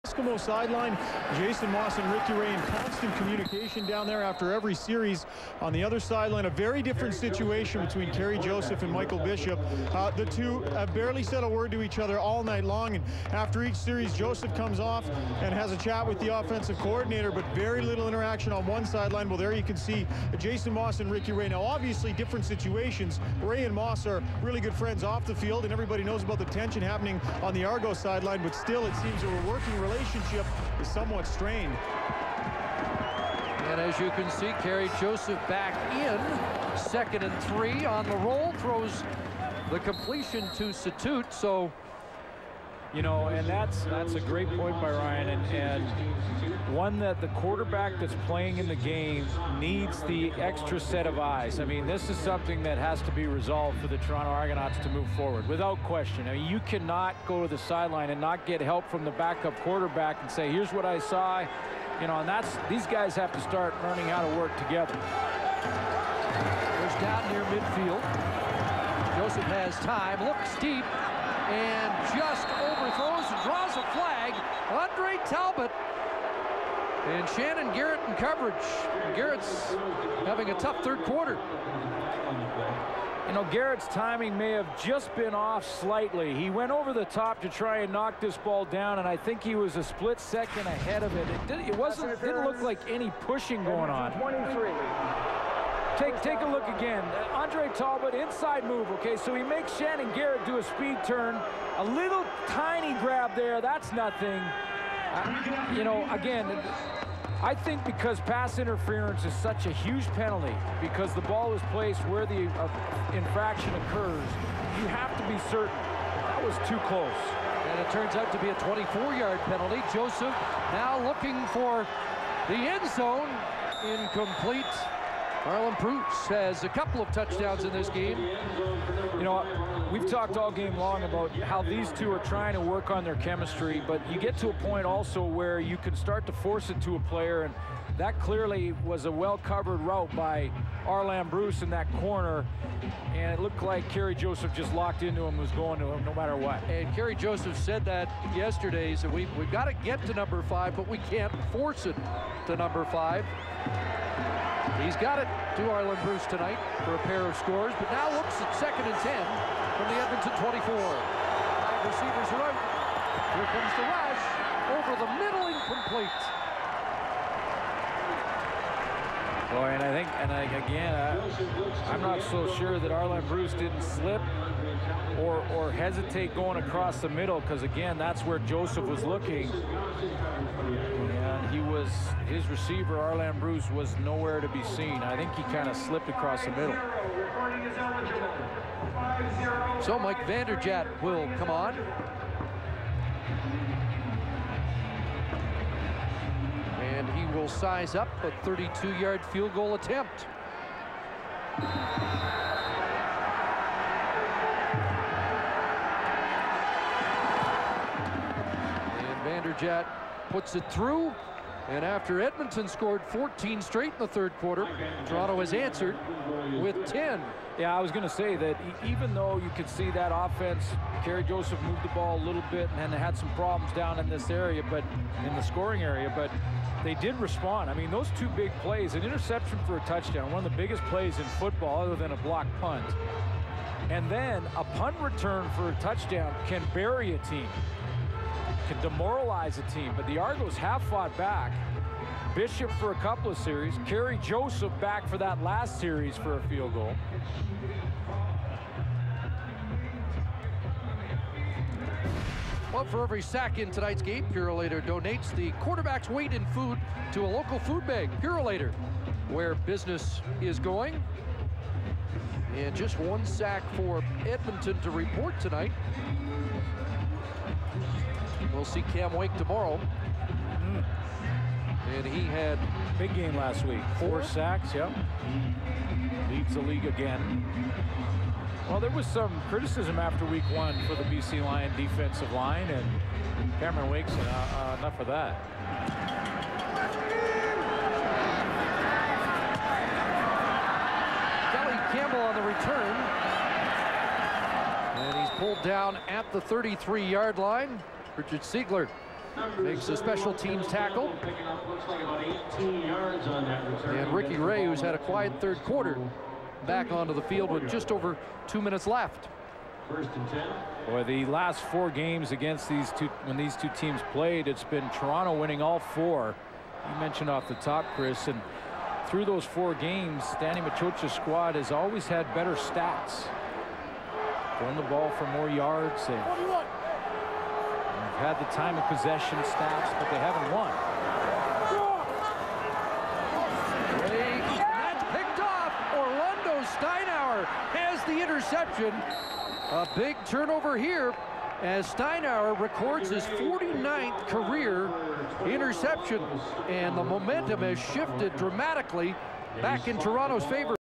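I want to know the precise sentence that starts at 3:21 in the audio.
And Vanderjagt puts it through and after Edmonton scored 14 straight in the third quarter, Toronto has answered with 10.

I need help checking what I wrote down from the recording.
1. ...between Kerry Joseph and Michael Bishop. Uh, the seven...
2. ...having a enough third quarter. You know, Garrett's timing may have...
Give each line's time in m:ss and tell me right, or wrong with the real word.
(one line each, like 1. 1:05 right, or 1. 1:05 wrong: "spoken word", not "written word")
1. 0:07 wrong: "two", not "seven"
2. 1:20 wrong: "tough", not "enough".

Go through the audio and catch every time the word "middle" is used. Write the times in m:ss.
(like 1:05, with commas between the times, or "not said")
2:45, 2:57, 3:06.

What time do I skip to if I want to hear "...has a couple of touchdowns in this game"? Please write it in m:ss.
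2:06.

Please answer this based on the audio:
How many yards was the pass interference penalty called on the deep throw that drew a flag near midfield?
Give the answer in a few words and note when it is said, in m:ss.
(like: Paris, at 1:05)
24, at 1:58.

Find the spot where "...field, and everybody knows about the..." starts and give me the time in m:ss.
0:25.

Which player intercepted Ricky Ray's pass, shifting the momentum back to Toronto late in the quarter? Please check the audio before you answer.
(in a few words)
Orlando Steinauer.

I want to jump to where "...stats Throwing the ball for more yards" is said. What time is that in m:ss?
5:22.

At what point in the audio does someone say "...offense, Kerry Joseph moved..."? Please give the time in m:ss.
3:40.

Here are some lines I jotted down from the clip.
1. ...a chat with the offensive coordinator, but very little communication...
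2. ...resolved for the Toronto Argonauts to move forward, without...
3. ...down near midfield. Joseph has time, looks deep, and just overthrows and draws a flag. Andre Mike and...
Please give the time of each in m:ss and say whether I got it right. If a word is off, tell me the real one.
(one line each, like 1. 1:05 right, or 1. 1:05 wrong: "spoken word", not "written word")
1. 0:15 wrong: "interaction", not "communication"
2. 0:53 right
3. 1:07 wrong: "Talbot", not "Mike".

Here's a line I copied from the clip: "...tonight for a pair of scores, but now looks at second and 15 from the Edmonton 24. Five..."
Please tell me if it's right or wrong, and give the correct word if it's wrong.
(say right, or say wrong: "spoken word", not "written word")
wrong: "10", not "15".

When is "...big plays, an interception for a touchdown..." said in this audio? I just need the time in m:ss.
3:48.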